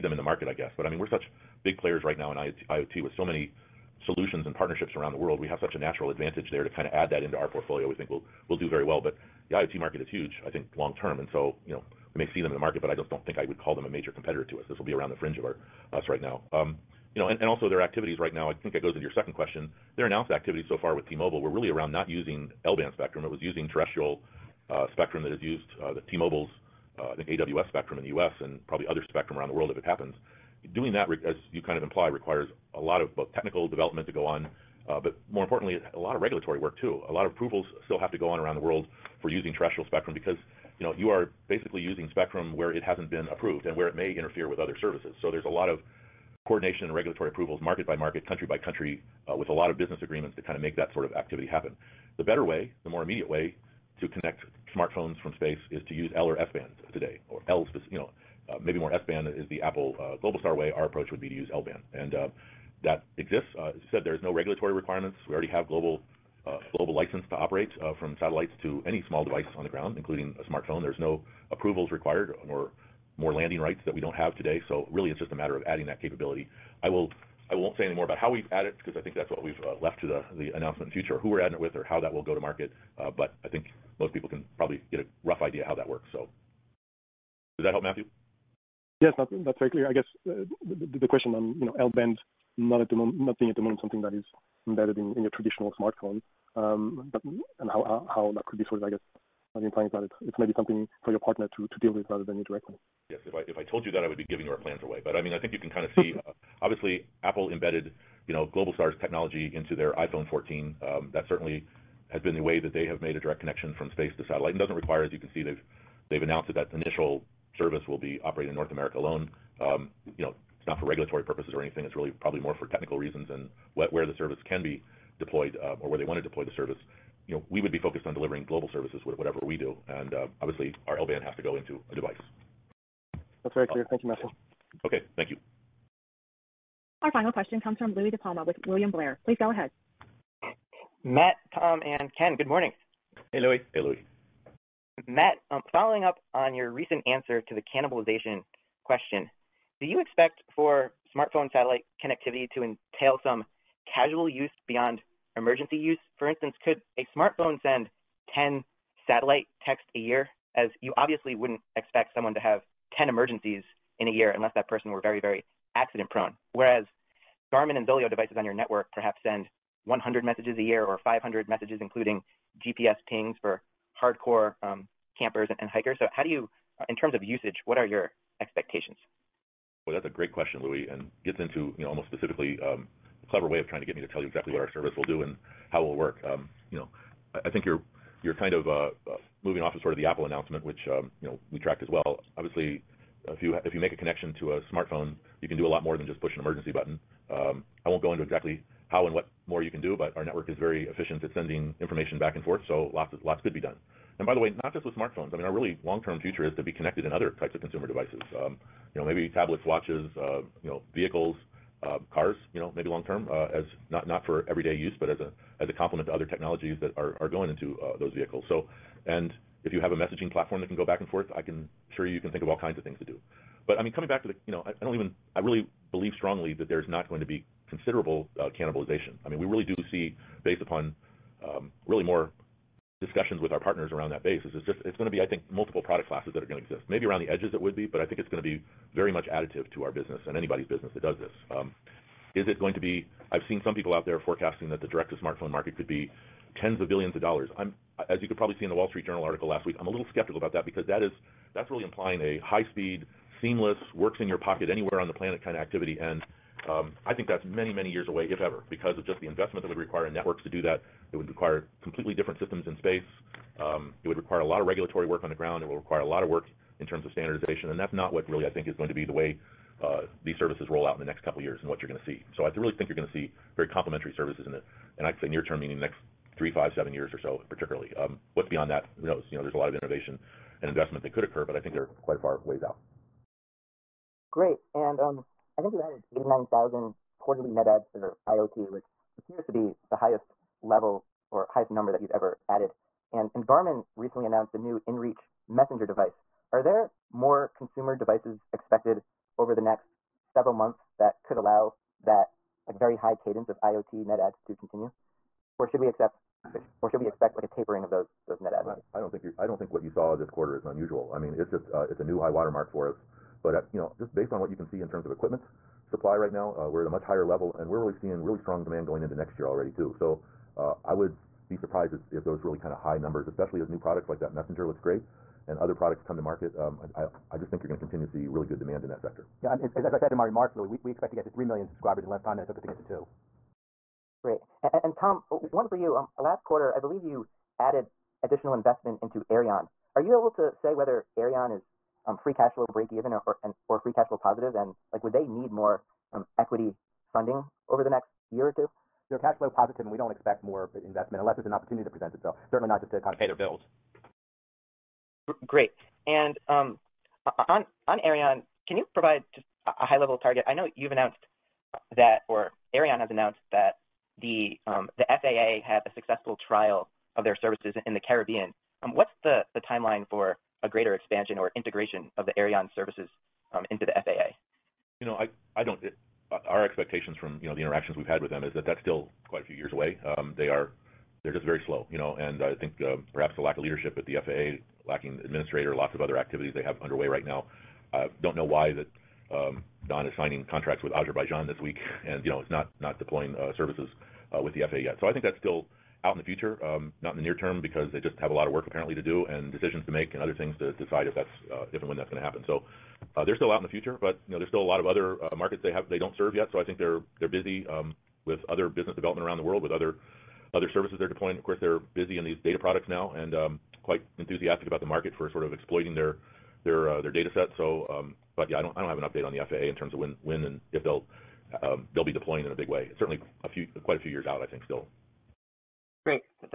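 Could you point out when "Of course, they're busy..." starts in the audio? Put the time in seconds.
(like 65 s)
411 s.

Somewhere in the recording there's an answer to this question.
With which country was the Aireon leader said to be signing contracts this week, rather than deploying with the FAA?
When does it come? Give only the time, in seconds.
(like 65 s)
390 s.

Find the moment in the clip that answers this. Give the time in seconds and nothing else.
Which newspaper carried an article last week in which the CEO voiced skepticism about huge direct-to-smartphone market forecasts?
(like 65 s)
248 s.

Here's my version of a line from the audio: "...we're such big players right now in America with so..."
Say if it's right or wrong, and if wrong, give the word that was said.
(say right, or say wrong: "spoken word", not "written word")
wrong: "IoT", not "America".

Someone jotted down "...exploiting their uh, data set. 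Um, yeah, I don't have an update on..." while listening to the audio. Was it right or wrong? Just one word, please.
right.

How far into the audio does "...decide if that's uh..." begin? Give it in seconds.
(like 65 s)
400 s.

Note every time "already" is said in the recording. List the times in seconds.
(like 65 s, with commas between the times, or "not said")
65 s, 319 s.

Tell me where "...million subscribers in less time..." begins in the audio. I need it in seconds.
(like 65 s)
331 s.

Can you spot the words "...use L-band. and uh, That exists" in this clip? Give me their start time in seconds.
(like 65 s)
61 s.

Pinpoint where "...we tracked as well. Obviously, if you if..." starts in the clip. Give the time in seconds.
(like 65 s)
191 s.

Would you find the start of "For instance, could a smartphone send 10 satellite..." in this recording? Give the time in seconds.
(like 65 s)
156 s.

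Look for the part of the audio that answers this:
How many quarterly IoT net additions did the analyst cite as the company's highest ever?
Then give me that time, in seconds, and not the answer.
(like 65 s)
286 s.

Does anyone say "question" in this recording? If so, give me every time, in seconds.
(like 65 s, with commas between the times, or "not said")
19 s, 91 s, 137 s, 148 s, 180 s.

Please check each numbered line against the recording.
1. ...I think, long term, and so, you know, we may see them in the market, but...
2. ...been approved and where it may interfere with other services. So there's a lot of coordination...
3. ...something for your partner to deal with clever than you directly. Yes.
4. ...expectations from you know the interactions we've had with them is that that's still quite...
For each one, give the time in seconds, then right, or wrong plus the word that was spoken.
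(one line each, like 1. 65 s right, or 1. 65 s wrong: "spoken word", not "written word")
1. 10 s right
2. 43 s right
3. 100 s wrong: "rather", not "clever"
4. 376 s right.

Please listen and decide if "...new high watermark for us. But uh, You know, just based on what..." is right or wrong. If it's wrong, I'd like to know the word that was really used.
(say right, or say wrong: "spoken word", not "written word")
right.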